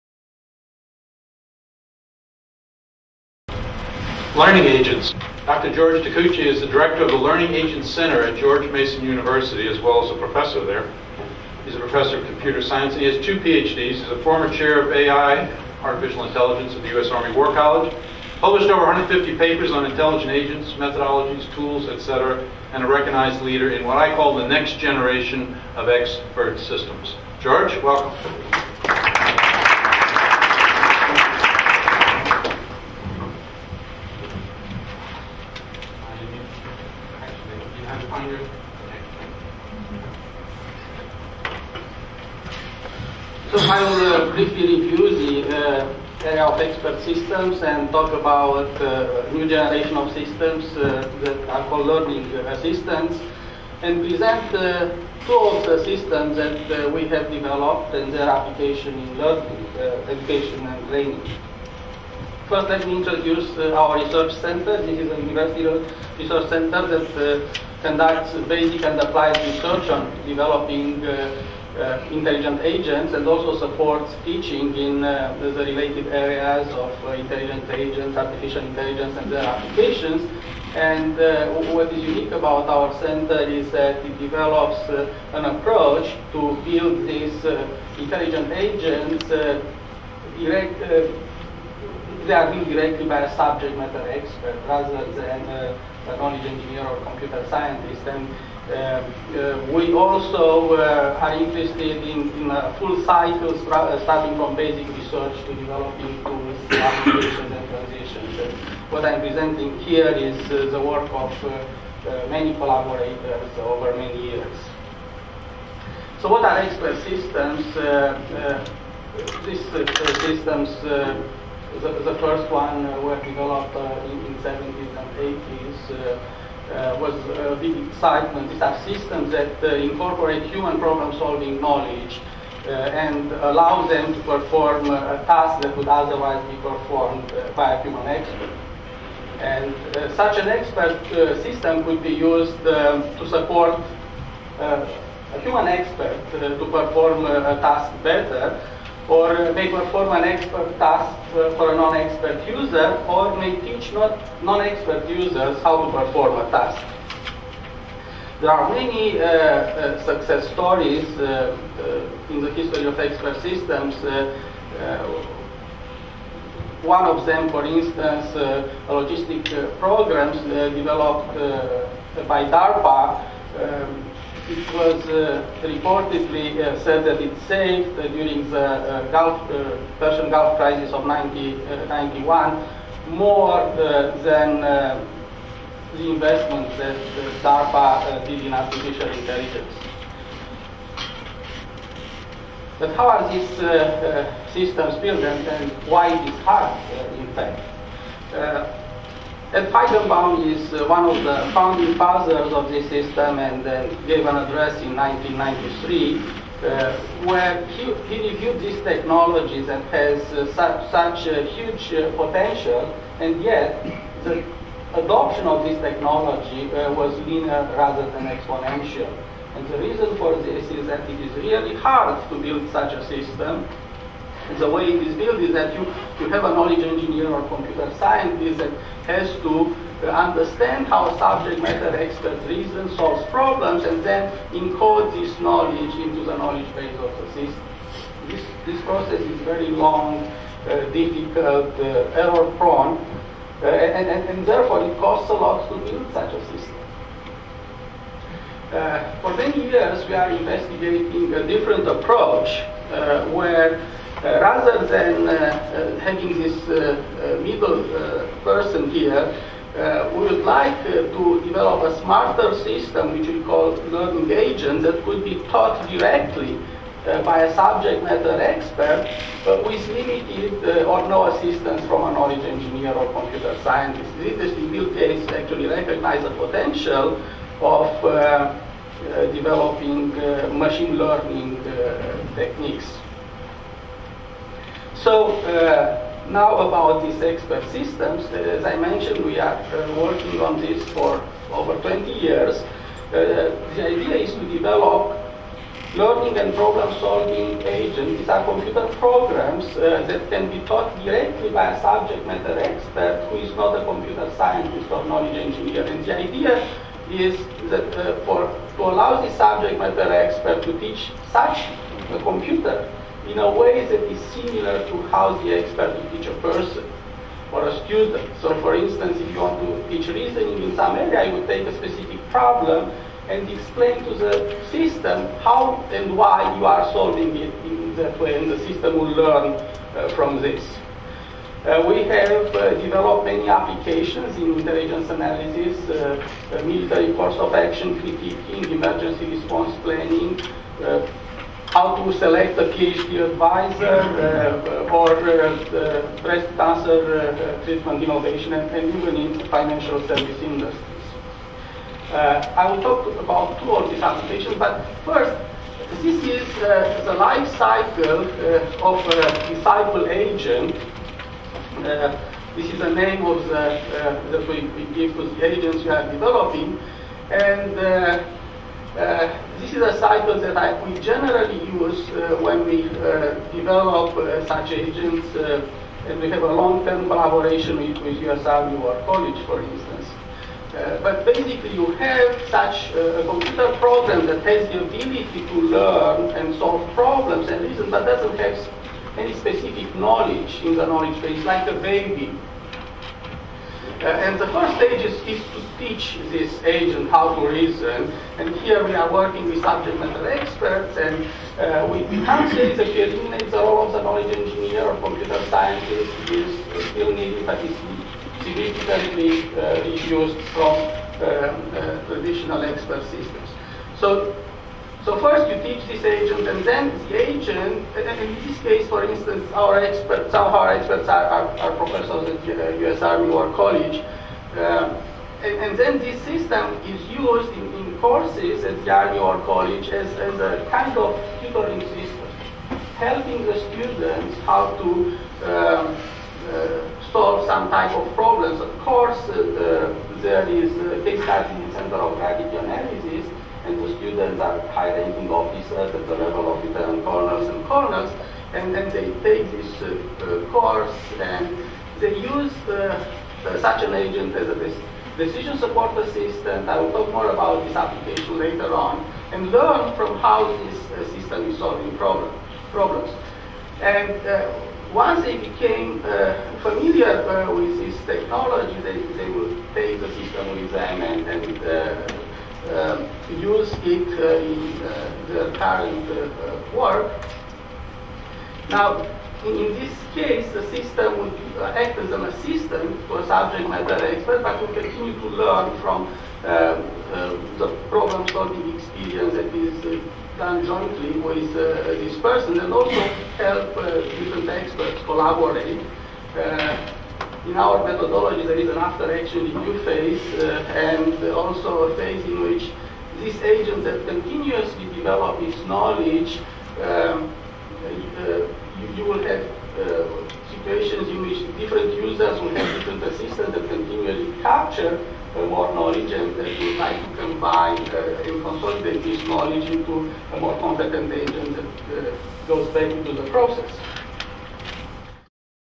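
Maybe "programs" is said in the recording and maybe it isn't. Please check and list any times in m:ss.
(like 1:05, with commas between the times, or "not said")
2:49, 4:58, 6:23.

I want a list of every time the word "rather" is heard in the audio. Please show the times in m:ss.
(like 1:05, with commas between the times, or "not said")
1:34, 3:37, 4:14.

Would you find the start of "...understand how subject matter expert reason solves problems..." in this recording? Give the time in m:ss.
3:50.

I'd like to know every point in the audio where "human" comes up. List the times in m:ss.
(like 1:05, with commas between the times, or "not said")
2:10, 2:17, 2:25.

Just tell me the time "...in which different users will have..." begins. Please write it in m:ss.
8:31.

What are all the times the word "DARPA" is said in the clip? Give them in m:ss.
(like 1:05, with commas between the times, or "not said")
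2:52, 3:07.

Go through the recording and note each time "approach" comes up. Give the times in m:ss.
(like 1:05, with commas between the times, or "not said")
1:25, 4:11.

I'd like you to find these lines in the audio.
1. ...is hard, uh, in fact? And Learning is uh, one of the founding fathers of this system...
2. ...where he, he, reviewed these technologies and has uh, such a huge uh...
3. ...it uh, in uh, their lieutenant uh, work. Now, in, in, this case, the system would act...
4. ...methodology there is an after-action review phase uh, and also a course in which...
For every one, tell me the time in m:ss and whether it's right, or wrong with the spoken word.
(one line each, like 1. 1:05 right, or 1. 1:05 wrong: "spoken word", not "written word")
1. 3:16 wrong: "Feigenbaum", not "Learning"
2. 3:27 right
3. 7:53 wrong: "current", not "lieutenant"
4. 8:17 wrong: "phase", not "course".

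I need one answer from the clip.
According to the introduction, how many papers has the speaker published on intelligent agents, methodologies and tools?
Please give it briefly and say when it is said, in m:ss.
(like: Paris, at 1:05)
over 150, at 0:18.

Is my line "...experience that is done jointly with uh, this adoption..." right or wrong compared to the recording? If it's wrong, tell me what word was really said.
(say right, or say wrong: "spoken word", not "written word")
wrong: "person", not "adoption".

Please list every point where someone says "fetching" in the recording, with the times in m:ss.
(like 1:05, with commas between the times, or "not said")
not said.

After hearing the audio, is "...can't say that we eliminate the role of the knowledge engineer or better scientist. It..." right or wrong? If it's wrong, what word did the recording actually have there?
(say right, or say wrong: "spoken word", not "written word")
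wrong: "computer", not "better".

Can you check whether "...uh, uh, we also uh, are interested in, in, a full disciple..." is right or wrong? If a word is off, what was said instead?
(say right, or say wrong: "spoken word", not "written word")
wrong: "cycle", not "disciple".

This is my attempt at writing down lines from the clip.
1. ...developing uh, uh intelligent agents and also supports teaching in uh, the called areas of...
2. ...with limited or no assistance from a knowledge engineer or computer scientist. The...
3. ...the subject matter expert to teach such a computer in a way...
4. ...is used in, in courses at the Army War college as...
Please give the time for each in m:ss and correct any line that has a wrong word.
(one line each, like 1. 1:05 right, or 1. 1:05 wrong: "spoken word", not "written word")
1. 1:10 wrong: "related", not "called"
2. 4:29 right
3. 5:09 right
4. 7:06 right.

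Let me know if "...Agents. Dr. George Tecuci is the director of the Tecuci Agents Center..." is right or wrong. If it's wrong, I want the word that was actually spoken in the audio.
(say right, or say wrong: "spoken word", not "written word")
wrong: "Learning", not "Tecuci".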